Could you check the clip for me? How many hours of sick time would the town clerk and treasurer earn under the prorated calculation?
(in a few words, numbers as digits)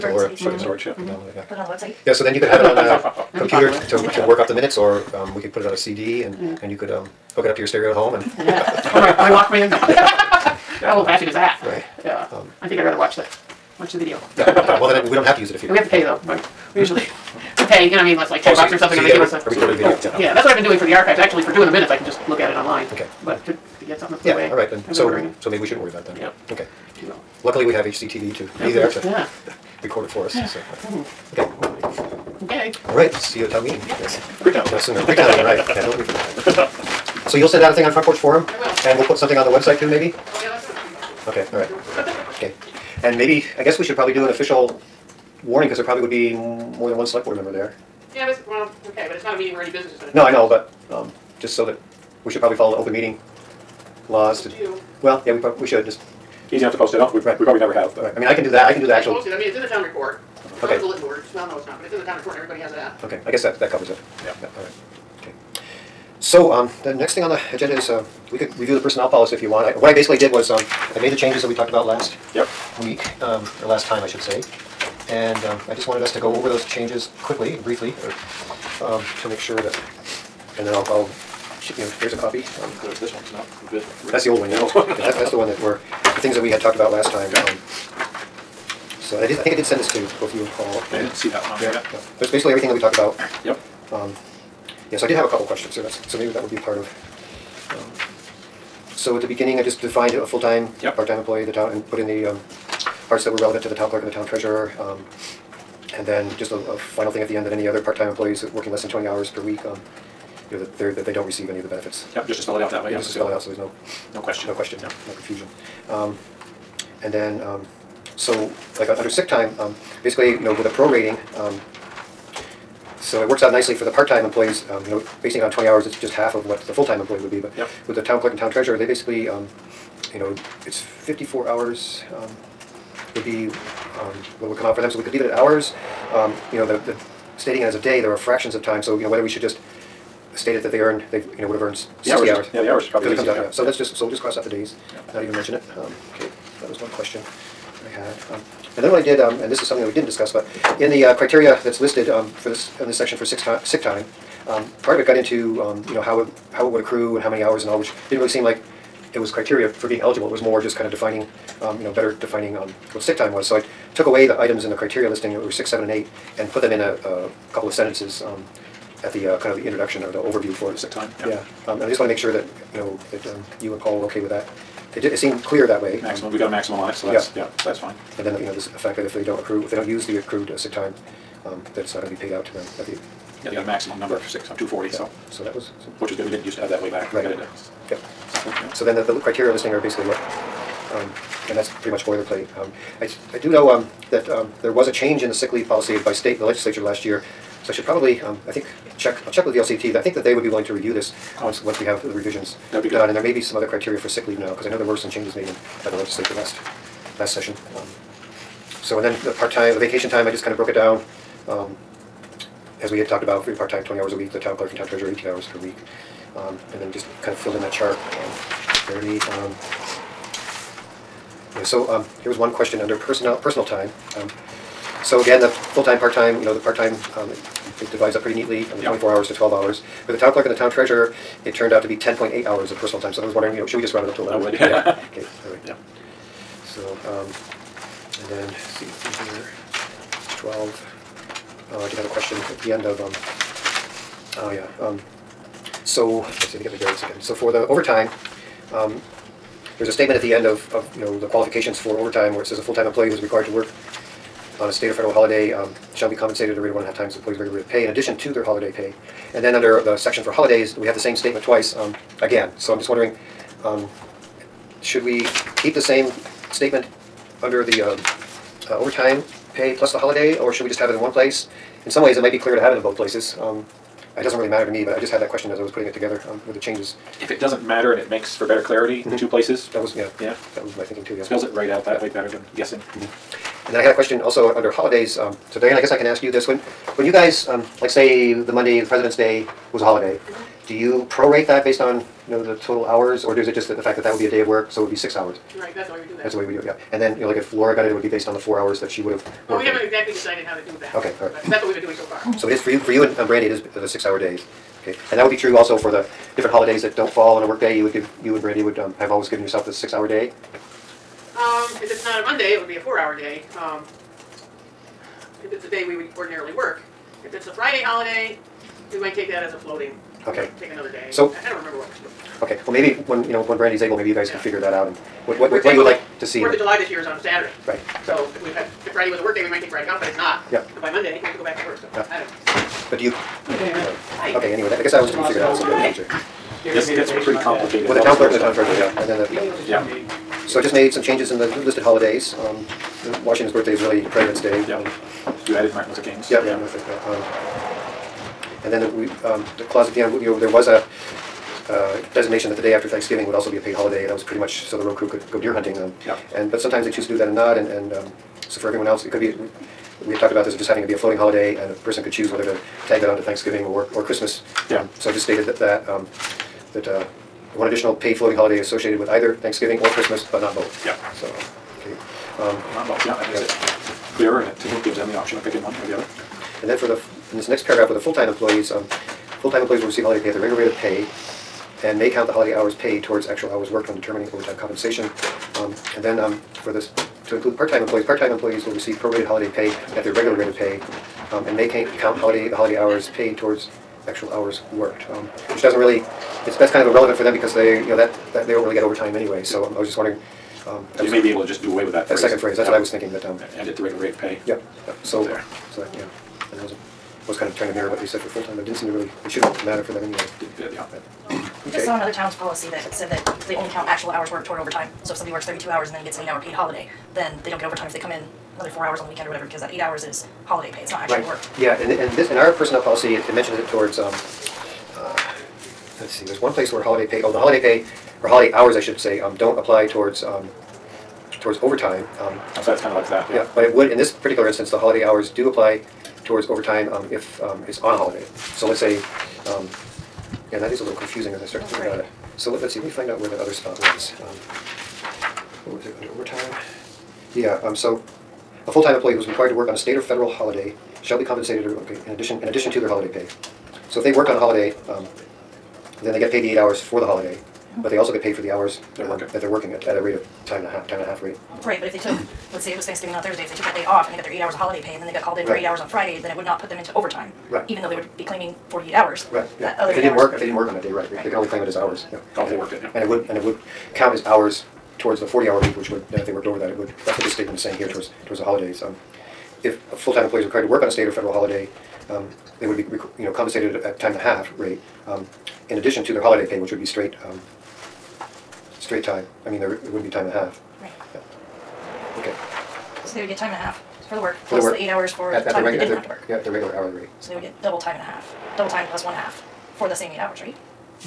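54.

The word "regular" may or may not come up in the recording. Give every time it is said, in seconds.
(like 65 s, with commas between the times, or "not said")
257 s, 380 s, 390 s, 403 s, 496 s.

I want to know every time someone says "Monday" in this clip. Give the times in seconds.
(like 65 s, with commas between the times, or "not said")
288 s, 312 s, 330 s.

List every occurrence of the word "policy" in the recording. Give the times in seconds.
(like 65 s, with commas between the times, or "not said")
69 s, 195 s, 412 s, 422 s.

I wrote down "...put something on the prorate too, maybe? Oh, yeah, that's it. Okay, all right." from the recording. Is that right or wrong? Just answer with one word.
wrong.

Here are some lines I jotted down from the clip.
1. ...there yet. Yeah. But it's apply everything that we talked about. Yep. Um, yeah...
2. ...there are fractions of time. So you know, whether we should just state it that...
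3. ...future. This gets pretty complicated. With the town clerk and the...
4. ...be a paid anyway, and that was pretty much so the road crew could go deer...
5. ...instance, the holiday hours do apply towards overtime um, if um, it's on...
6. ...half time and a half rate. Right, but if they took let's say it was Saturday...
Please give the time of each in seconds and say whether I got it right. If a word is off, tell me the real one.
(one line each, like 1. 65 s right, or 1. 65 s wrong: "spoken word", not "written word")
1. 91 s wrong: "basically", not "apply"
2. 138 s right
3. 335 s right
4. 353 s wrong: "holiday", not "anyway"
5. 434 s right
6. 460 s wrong: "Thanksgiving", not "Saturday".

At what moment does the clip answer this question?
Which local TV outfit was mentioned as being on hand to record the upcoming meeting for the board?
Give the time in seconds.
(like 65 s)
27 s.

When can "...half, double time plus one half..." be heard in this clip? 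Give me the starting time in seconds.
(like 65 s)
498 s.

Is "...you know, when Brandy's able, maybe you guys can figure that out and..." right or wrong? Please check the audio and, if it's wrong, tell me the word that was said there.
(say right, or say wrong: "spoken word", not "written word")
right.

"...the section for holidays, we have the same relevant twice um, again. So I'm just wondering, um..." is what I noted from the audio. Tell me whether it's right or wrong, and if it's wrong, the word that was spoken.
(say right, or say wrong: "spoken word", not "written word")
wrong: "statement", not "relevant".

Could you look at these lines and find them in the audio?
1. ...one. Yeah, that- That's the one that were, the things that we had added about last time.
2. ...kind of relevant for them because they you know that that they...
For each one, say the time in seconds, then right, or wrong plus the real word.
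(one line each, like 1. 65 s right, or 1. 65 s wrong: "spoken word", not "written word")
1. 84 s wrong: "talked", not "added"
2. 396 s wrong: "irrelevant", not "relevant".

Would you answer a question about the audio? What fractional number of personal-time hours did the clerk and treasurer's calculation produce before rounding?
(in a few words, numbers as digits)
10.8.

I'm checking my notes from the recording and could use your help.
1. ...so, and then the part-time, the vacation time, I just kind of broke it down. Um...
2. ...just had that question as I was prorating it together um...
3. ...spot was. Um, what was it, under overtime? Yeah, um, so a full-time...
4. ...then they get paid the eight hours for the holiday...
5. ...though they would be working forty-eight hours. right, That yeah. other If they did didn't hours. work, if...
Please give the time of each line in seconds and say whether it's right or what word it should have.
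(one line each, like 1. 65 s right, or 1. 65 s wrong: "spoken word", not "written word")
1. 208 s right
2. 275 s wrong: "putting", not "prorating"
3. 443 s right
4. 456 s right
5. 467 s wrong: "claiming", not "working".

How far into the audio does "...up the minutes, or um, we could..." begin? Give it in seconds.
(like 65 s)
4 s.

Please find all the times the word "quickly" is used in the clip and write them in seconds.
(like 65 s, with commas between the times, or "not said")
77 s.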